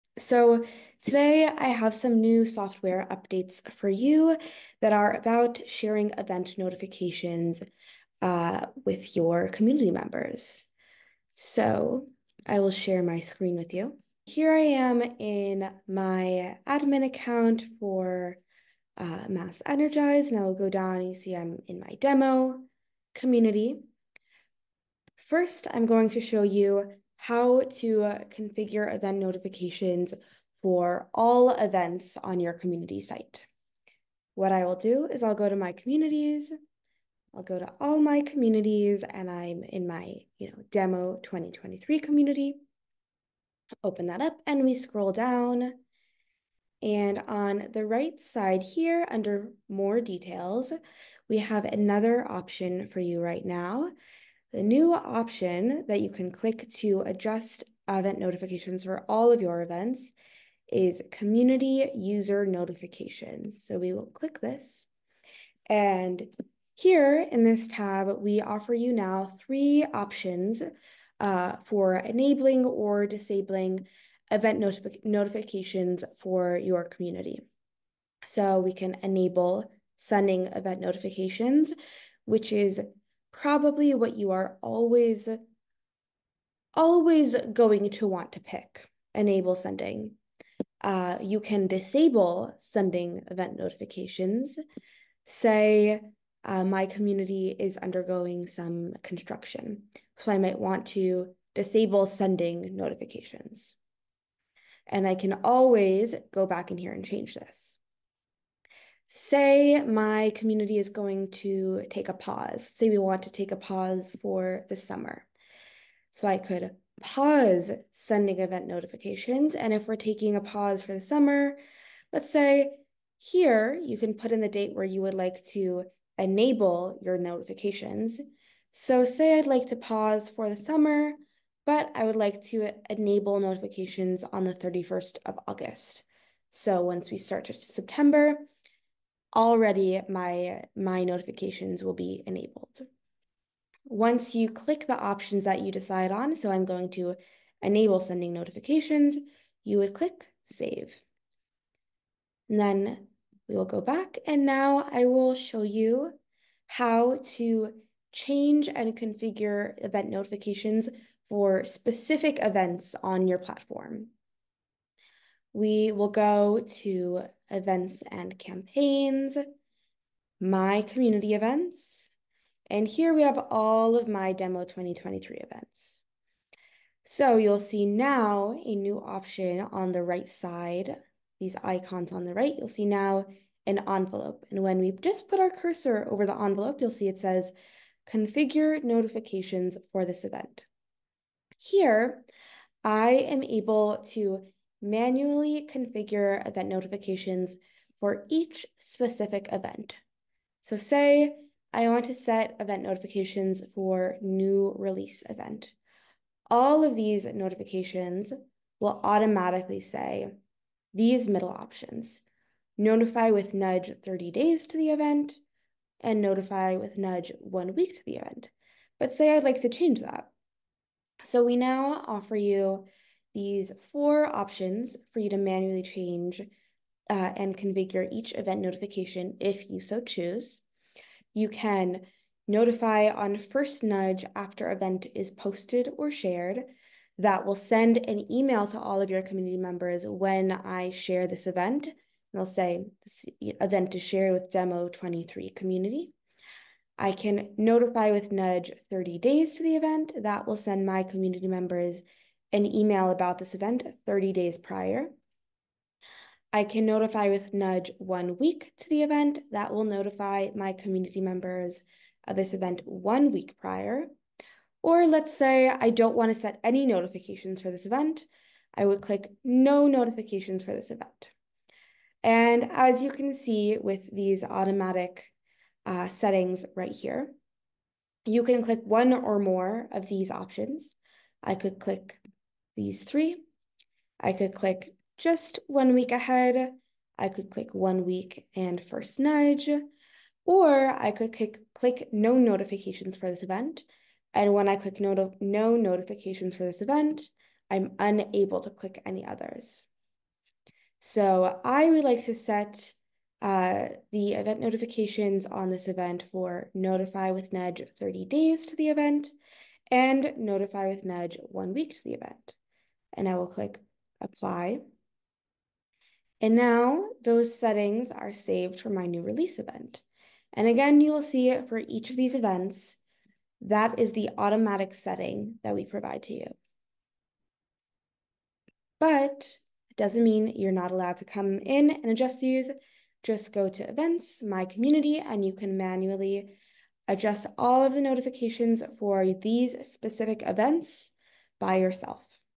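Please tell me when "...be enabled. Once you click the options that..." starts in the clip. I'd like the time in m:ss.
2:21.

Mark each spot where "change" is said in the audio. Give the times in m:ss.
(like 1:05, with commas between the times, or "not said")
1:47, 2:38, 3:39, 3:45.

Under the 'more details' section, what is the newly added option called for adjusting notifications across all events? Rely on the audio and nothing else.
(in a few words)
community user notifications.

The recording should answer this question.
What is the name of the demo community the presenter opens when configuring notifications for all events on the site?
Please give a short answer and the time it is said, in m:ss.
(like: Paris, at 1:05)
demo 2023, at 0:40.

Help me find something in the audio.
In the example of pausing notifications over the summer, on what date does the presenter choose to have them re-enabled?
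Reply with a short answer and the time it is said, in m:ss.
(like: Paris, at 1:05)
31st of August, at 2:14.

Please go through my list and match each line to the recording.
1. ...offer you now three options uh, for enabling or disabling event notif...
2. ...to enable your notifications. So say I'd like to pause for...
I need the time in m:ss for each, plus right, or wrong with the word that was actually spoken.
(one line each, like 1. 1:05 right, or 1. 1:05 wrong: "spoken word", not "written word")
1. 1:08 right
2. 2:05 right.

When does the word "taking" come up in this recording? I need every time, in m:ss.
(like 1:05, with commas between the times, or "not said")
1:59.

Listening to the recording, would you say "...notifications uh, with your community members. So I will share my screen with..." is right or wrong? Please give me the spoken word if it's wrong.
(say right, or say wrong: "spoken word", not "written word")
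right.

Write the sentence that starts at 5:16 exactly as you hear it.
And now those settings are saved for my new release event.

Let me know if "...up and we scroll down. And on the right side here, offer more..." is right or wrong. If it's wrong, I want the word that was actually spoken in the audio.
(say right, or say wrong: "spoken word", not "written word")
wrong: "under", not "offer".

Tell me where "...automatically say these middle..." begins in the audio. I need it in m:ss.
3:29.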